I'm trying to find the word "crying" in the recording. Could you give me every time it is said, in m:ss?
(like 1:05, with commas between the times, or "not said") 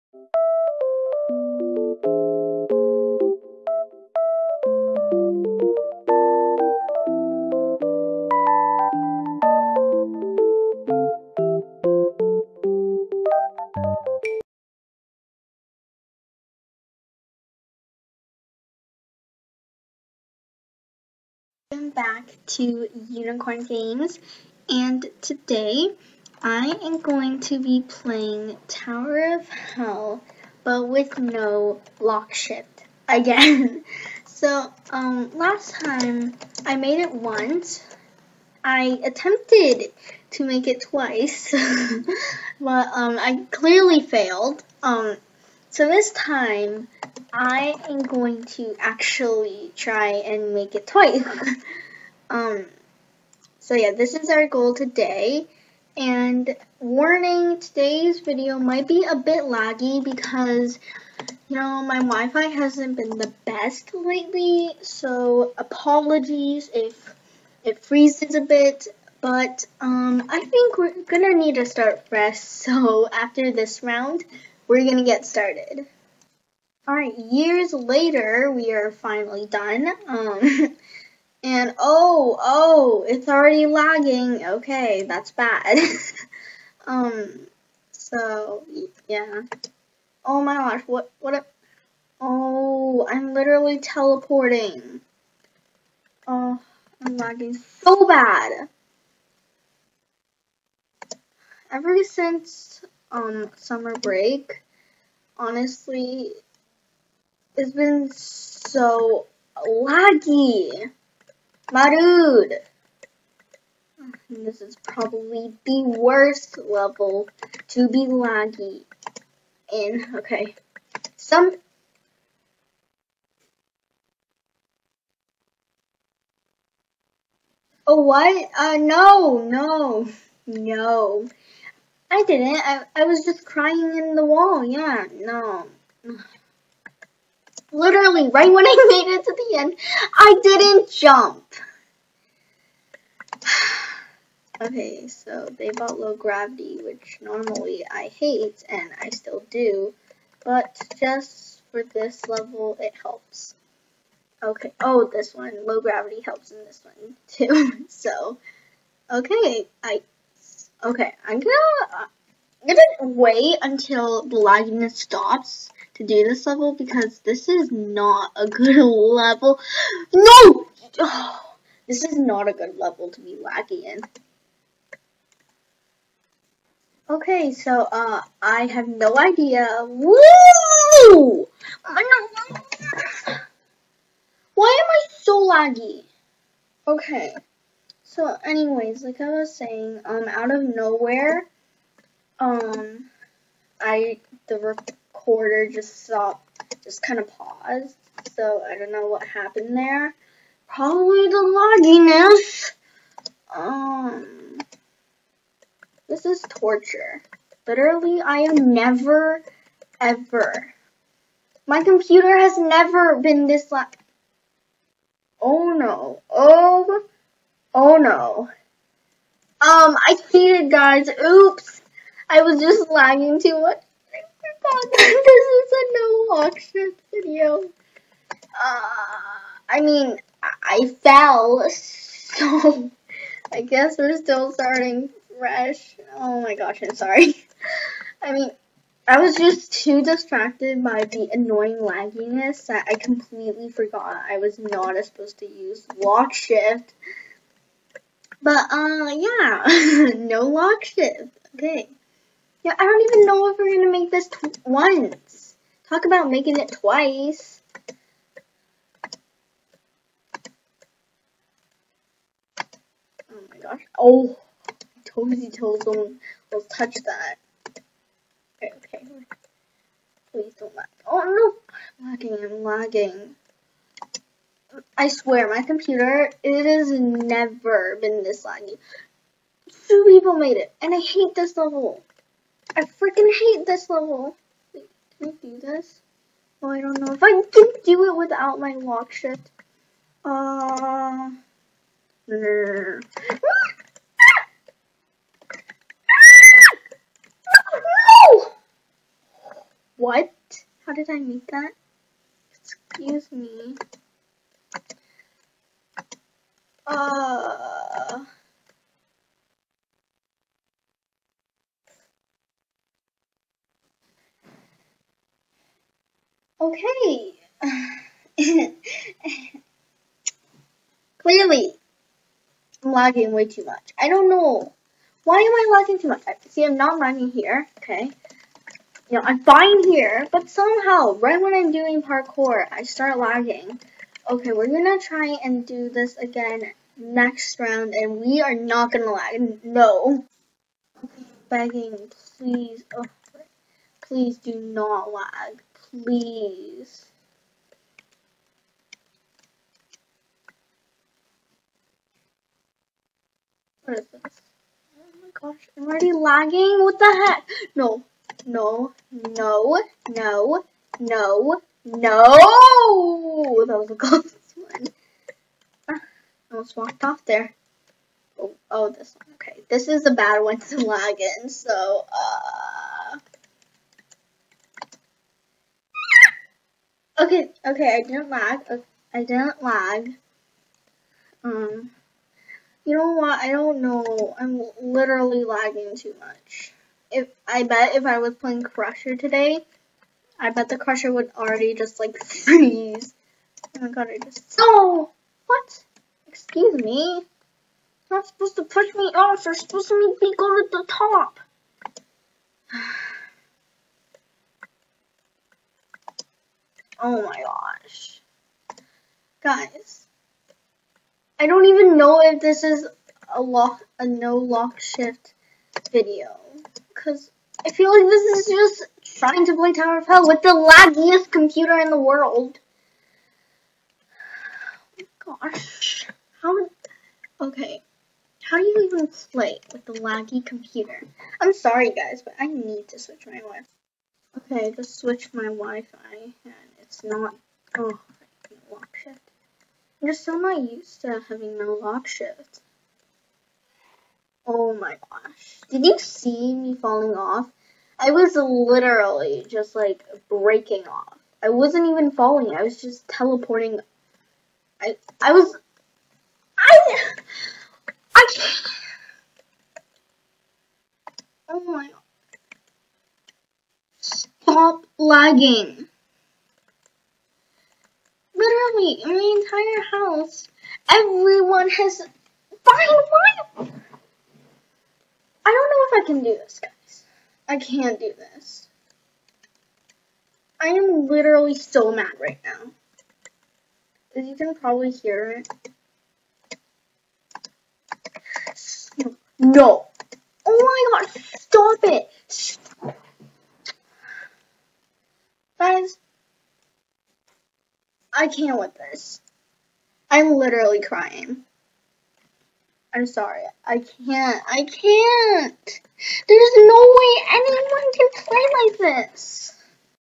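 2:13, 8:20.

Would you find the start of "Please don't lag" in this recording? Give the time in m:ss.
4:30.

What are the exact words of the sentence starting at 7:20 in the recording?
I'm just not used to having no lock shift.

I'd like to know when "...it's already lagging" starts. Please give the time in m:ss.
1:23.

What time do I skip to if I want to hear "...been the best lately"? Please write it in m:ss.
1:02.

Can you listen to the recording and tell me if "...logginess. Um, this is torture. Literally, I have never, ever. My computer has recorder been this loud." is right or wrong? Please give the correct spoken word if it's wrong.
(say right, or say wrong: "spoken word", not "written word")
wrong: "never", not "recorder".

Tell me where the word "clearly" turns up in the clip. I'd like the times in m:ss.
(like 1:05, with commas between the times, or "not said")
0:43, 5:21.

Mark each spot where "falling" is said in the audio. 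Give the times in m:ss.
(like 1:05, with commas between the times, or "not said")
7:26, 7:32.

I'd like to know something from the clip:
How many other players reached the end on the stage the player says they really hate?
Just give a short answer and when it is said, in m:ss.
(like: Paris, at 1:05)
2, at 4:39.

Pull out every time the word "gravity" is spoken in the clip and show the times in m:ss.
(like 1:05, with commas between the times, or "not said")
2:26, 2:35.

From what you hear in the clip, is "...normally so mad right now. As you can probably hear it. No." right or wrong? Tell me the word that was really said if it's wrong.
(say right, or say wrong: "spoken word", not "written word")
wrong: "literally", not "normally".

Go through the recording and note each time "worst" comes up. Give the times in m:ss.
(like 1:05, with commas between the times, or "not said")
1:55.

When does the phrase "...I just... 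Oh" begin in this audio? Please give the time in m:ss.
6:34.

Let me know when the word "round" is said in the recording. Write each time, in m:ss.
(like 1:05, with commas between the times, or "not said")
1:13, 5:37.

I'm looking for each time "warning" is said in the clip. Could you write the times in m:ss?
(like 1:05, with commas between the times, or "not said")
0:56.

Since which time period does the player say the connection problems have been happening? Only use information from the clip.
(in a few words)
summer break.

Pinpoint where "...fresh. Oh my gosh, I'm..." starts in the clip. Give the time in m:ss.
3:55.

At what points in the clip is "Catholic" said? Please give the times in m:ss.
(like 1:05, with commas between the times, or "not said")
not said.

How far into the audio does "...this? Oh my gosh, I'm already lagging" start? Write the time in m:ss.
5:54.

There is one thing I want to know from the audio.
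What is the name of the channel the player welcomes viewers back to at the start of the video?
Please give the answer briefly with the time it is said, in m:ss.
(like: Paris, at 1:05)
Unicorn Games, at 0:23.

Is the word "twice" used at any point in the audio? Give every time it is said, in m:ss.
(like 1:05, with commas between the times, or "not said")
0:40, 0:50, 4:16.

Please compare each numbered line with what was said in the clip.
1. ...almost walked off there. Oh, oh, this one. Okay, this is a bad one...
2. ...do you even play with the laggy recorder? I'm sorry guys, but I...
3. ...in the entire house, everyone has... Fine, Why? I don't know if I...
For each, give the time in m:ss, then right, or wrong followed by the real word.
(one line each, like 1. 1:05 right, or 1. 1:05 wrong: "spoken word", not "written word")
1. 6:06 right
2. 7:08 wrong: "computer", not "recorder"
3. 7:49 right.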